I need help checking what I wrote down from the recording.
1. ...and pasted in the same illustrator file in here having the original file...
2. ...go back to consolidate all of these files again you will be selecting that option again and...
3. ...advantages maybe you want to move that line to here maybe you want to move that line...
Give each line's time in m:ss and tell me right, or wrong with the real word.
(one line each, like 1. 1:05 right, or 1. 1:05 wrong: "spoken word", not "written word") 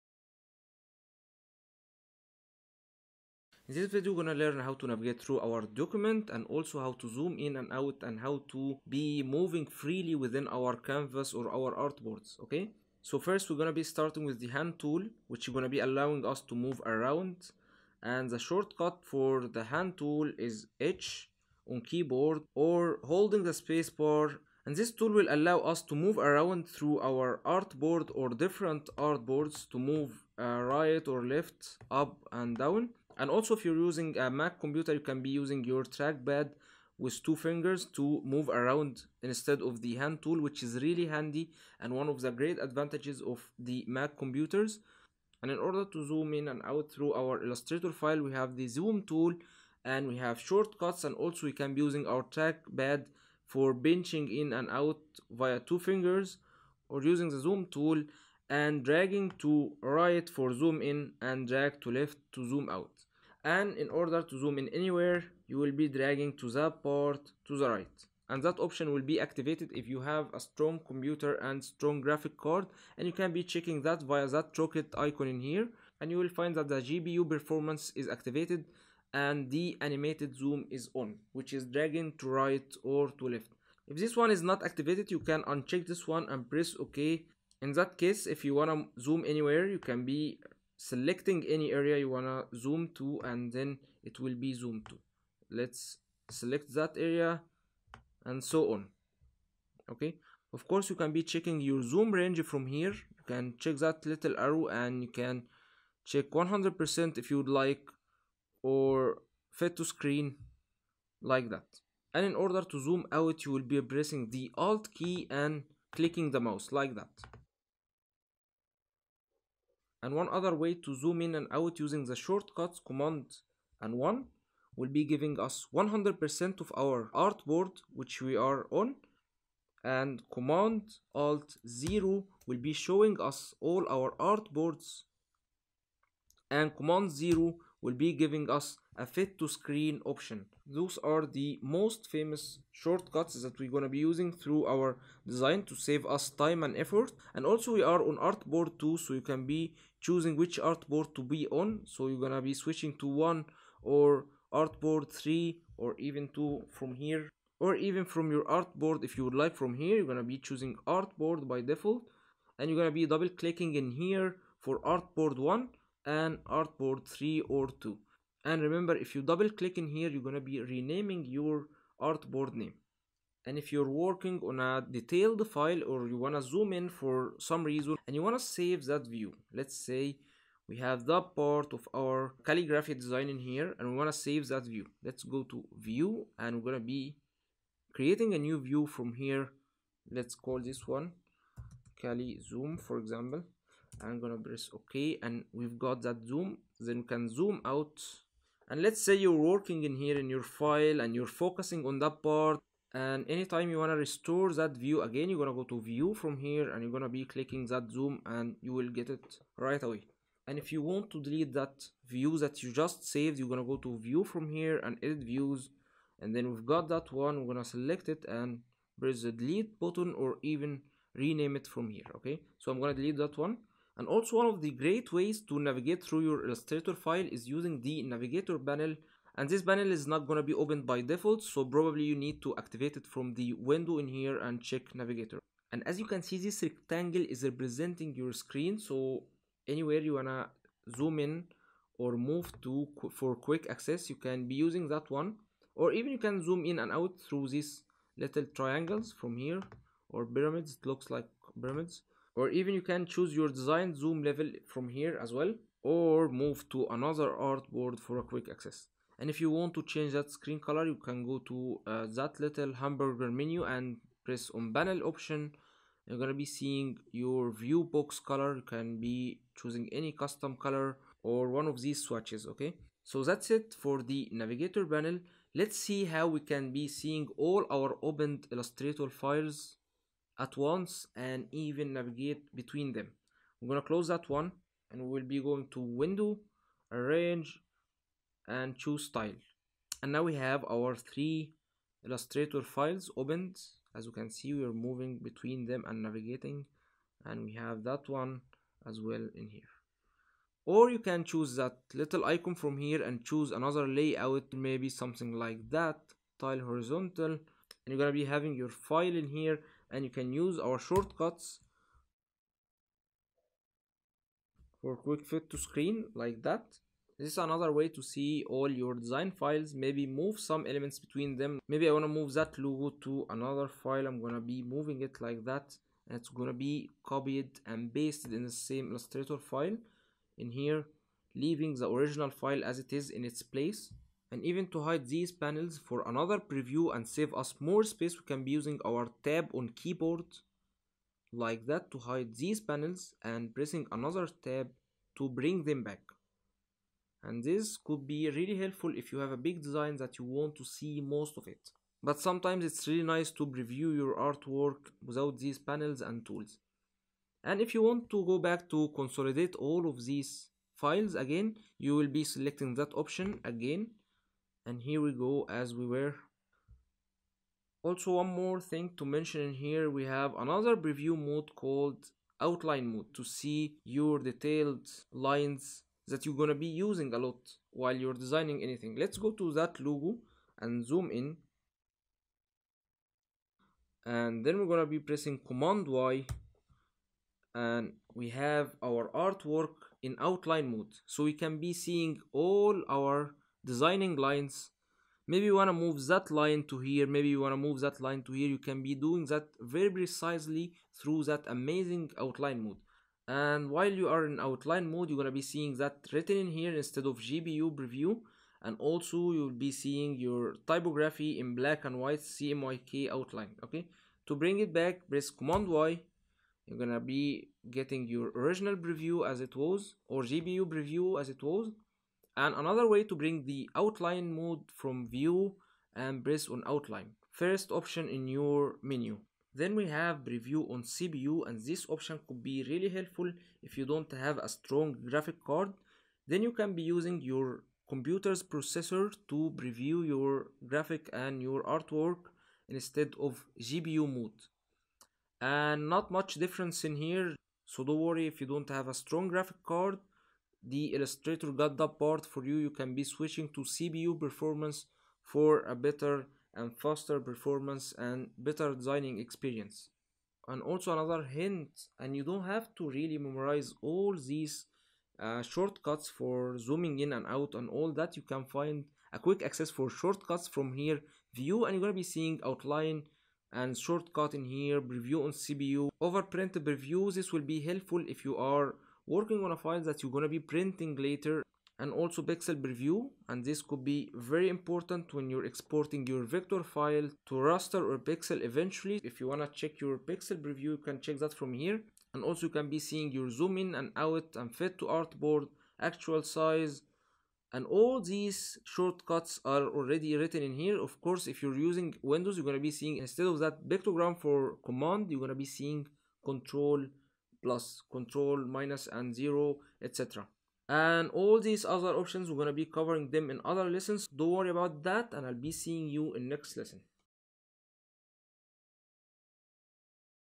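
1. 5:27 wrong: "leaving", not "having"
2. 5:58 right
3. 6:34 wrong: "lines", not "advantages".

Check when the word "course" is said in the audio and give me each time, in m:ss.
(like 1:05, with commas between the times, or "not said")
1:40, 8:21.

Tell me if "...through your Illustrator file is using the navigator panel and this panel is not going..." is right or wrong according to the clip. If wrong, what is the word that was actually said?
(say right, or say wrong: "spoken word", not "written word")
right.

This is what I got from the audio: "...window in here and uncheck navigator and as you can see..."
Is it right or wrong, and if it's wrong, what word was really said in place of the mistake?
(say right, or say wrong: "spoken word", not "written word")
wrong: "check", not "uncheck".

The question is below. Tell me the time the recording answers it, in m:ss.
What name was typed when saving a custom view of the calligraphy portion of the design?
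3:12.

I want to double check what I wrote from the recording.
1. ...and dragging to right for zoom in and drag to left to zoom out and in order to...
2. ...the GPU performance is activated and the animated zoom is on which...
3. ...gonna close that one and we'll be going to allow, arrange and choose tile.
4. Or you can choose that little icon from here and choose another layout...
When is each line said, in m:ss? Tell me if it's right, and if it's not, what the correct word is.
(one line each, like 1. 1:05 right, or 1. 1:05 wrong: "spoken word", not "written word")
1. 0:58 right
2. 1:16 right
3. 4:43 wrong: "window", not "allow"
4. 5:00 right.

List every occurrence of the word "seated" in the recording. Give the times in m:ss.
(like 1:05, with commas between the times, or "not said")
not said.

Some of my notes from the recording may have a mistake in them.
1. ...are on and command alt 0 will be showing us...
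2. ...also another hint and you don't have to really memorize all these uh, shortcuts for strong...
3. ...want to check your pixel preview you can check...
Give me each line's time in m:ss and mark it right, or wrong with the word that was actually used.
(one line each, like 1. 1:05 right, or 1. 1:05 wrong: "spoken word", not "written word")
1. 2:08 right
2. 7:40 wrong: "zooming", not "strong"
3. 8:09 right.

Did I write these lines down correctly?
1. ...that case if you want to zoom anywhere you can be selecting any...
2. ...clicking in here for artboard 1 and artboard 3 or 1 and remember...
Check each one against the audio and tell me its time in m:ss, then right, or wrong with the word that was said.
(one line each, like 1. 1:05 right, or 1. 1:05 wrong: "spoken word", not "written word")
1. 1:27 right
2. 2:43 wrong: "2", not "1".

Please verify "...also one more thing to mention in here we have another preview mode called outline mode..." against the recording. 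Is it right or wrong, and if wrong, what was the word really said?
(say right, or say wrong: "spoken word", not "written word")
right.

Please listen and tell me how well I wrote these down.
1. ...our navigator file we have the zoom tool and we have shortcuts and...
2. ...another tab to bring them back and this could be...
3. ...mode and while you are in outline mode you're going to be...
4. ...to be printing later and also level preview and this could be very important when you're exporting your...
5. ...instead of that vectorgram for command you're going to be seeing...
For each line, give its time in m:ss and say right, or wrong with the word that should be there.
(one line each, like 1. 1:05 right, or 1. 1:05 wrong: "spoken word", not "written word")
1. 0:47 wrong: "illustrator", not "navigator"
2. 5:43 right
3. 6:42 right
4. 8:00 wrong: "pixel", not "level"
5. 8:22 right.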